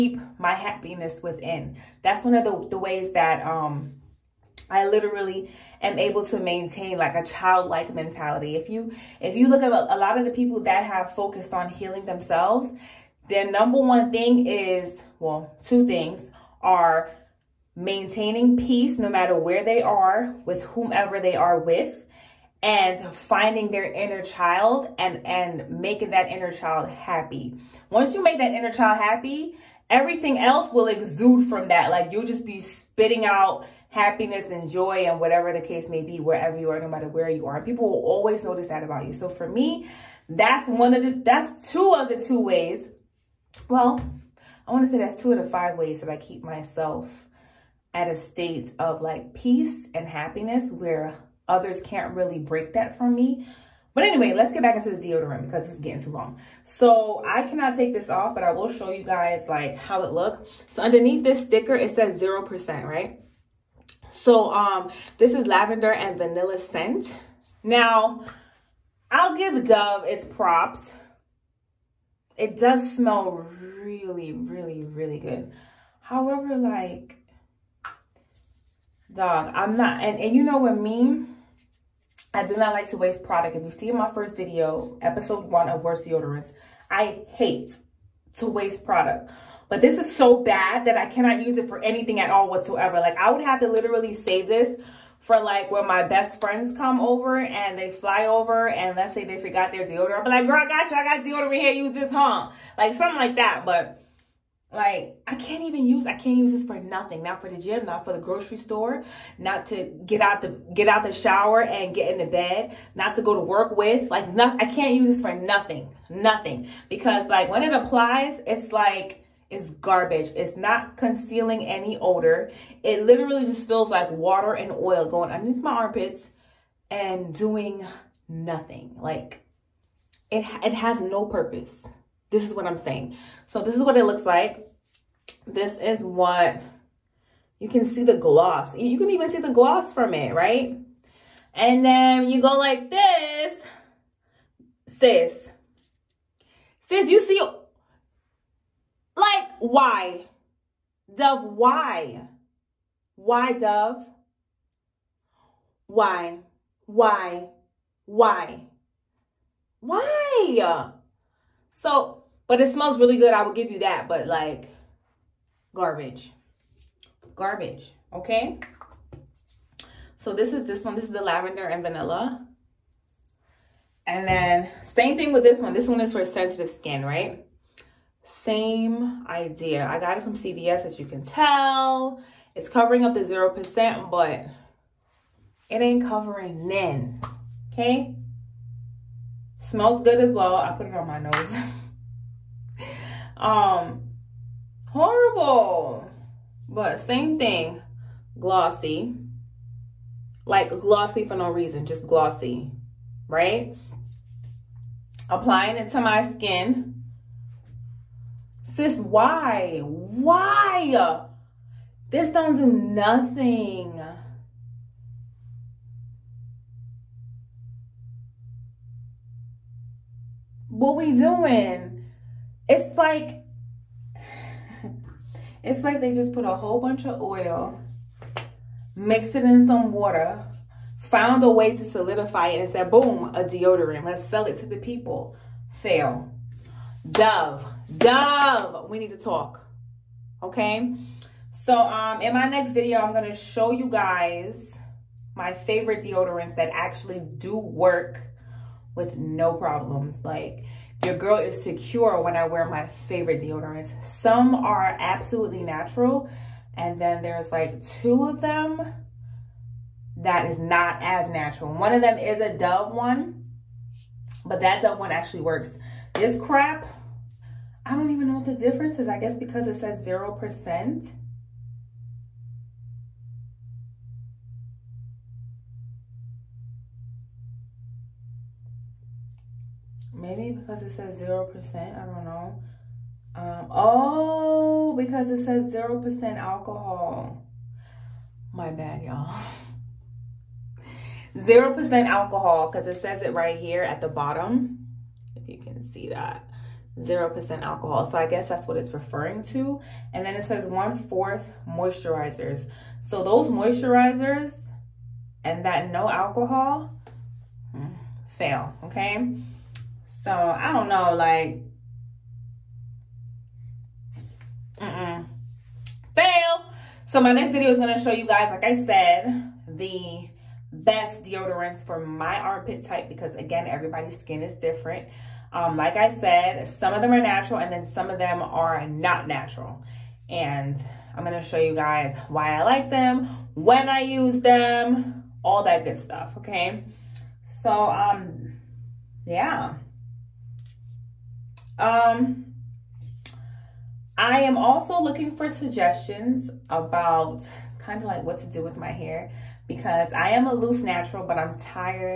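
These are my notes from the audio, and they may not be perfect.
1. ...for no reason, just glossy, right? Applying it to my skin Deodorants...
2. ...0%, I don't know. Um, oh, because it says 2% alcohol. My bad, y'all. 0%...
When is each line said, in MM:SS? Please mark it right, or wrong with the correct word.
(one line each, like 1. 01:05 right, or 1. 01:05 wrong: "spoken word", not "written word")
1. 03:21 wrong: "Sis", not "Deodorants"
2. 04:41 wrong: "0", not "2".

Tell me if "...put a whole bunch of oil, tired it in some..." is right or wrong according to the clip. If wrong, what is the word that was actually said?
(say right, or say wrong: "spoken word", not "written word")
wrong: "mixed", not "tired".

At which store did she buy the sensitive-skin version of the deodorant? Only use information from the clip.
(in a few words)
CVS.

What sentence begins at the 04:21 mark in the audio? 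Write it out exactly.
One of them is a Dove one, but that Dove one actually works is crap.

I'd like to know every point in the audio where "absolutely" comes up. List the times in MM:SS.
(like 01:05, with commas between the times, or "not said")
04:14.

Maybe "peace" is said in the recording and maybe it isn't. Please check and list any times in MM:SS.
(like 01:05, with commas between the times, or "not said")
00:18, 00:49.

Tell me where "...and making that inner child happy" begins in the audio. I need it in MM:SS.
00:25.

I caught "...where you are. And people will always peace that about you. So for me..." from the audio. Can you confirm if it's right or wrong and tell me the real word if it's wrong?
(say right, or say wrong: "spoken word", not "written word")
wrong: "notice", not "peace".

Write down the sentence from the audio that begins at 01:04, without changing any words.
So um, this is lavender and vanilla scent.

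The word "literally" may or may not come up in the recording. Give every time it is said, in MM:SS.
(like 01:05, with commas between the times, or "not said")
00:04, 01:33, 02:03.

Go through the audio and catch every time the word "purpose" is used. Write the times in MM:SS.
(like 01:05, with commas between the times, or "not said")
02:11.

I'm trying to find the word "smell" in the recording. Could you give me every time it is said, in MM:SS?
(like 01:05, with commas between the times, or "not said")
01:12, 02:42, 03:09.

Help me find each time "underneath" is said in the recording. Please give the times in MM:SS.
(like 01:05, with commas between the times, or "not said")
01:00, 02:05.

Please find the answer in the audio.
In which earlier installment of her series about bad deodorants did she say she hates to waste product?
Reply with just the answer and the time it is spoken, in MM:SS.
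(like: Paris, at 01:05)
episode one, at 01:25.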